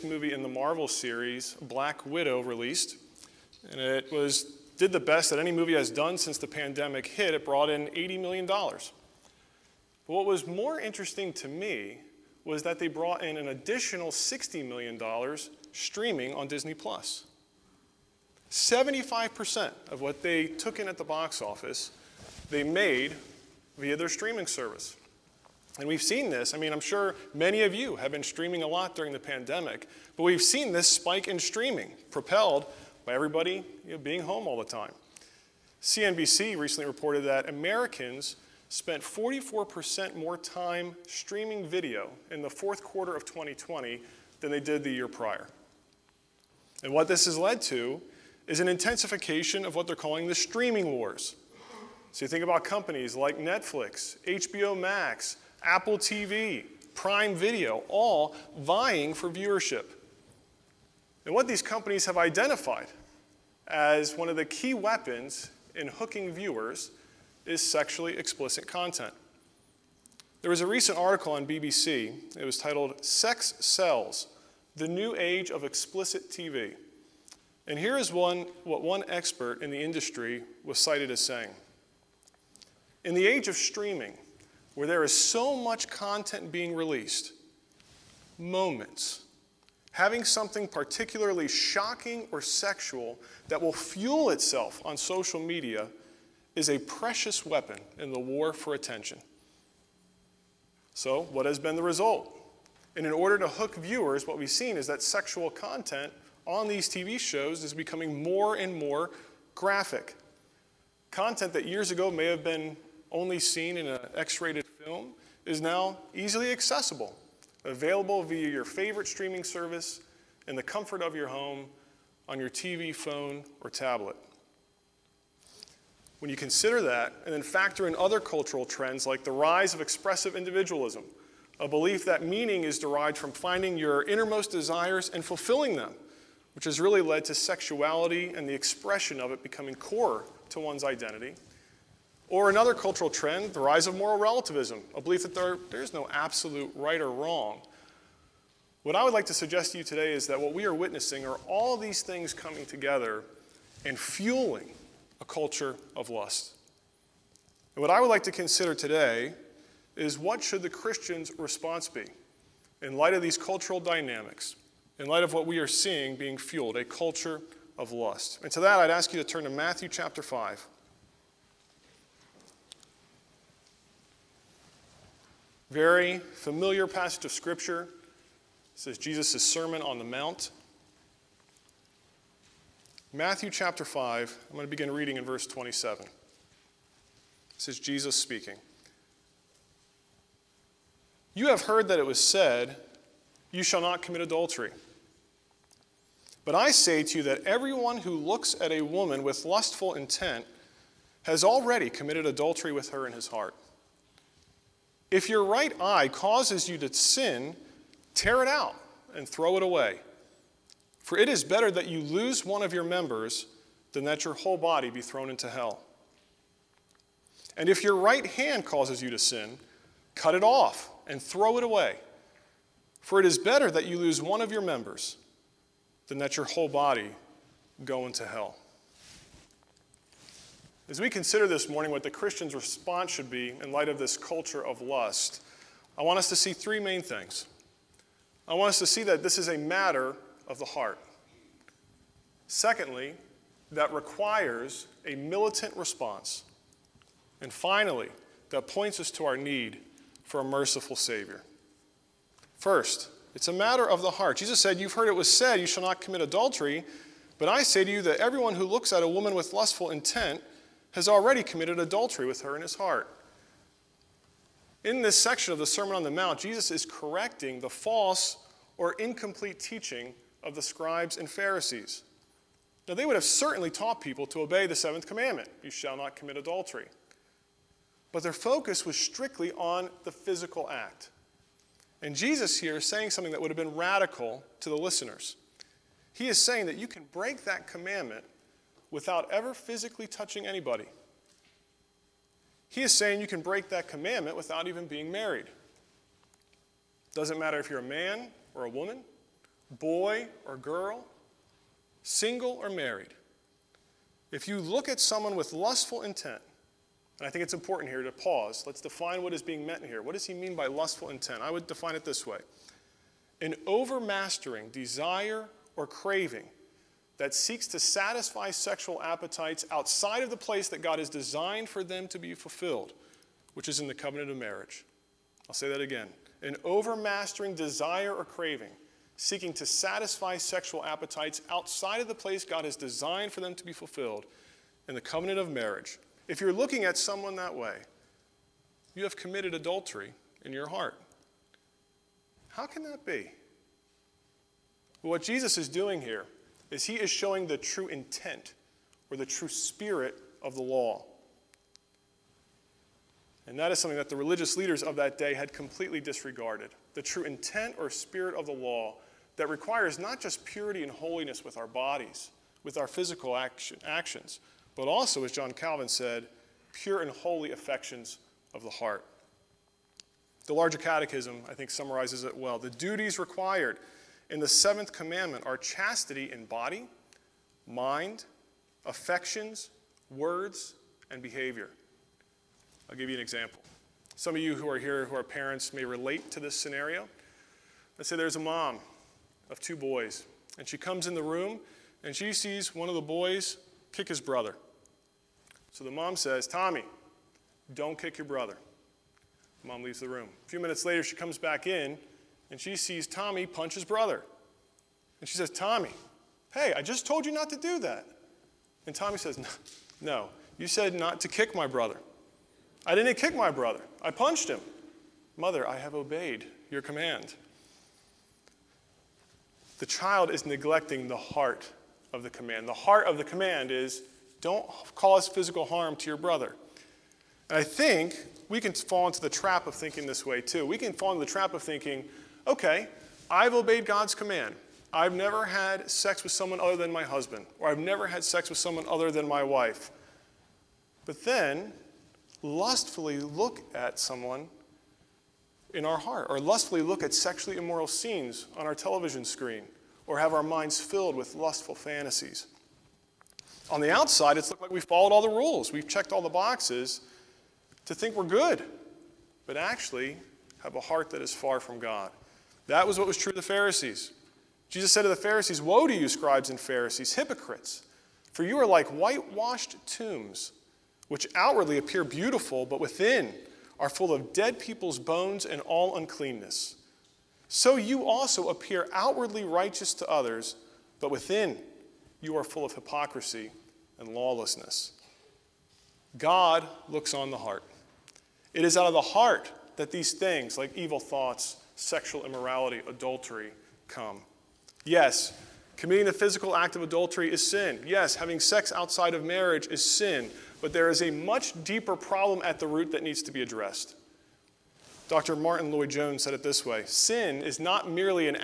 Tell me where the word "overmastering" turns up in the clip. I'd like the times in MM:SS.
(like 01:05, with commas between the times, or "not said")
05:13, 05:26.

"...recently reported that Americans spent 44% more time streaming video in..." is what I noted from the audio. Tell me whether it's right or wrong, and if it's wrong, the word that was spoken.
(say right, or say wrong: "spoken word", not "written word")
right.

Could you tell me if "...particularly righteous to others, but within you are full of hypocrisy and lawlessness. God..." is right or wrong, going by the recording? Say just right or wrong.
wrong.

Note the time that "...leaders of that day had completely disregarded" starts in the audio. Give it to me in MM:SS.
05:54.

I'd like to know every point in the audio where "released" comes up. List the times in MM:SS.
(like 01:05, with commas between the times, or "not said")
00:02, 01:26.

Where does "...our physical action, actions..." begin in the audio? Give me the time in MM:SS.
06:02.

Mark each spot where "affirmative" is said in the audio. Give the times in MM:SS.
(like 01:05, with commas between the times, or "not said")
not said.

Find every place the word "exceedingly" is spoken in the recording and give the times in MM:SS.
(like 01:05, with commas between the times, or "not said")
not said.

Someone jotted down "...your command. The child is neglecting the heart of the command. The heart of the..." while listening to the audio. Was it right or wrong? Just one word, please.
right.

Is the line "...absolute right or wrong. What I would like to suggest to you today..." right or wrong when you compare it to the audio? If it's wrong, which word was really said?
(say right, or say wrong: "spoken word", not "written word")
right.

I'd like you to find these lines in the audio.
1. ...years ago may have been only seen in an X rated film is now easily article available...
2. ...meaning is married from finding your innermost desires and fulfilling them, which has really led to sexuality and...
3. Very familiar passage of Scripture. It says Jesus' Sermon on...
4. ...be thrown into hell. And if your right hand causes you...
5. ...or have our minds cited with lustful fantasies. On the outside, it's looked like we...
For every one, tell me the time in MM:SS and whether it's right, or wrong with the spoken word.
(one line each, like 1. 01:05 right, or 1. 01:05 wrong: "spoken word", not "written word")
1. 01:51 wrong: "accessible", not "article"
2. 02:12 wrong: "derived", not "married"
3. 02:55 right
4. 03:34 right
5. 07:30 wrong: "filled", not "cited".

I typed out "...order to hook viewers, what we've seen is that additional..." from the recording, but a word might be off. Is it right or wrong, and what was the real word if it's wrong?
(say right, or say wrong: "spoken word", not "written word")
wrong: "sexual", not "additional".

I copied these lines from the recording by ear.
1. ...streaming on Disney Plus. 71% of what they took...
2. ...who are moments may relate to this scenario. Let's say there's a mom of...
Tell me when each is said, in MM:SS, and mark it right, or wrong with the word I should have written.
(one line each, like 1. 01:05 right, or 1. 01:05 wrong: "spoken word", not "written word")
1. 00:15 wrong: "75", not "71"
2. 06:25 wrong: "parents", not "moments".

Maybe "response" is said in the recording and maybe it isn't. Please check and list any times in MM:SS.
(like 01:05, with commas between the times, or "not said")
02:41, 03:52, 04:05.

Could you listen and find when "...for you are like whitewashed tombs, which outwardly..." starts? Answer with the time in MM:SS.
07:48.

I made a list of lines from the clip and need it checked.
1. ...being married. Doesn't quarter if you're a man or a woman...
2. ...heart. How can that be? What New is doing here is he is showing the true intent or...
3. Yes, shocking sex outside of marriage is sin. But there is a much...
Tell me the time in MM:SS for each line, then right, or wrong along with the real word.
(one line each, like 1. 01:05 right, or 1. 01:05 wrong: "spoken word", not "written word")
1. 04:54 wrong: "matter", not "quarter"
2. 05:40 wrong: "Jesus", not "New"
3. 08:17 wrong: "having", not "shocking".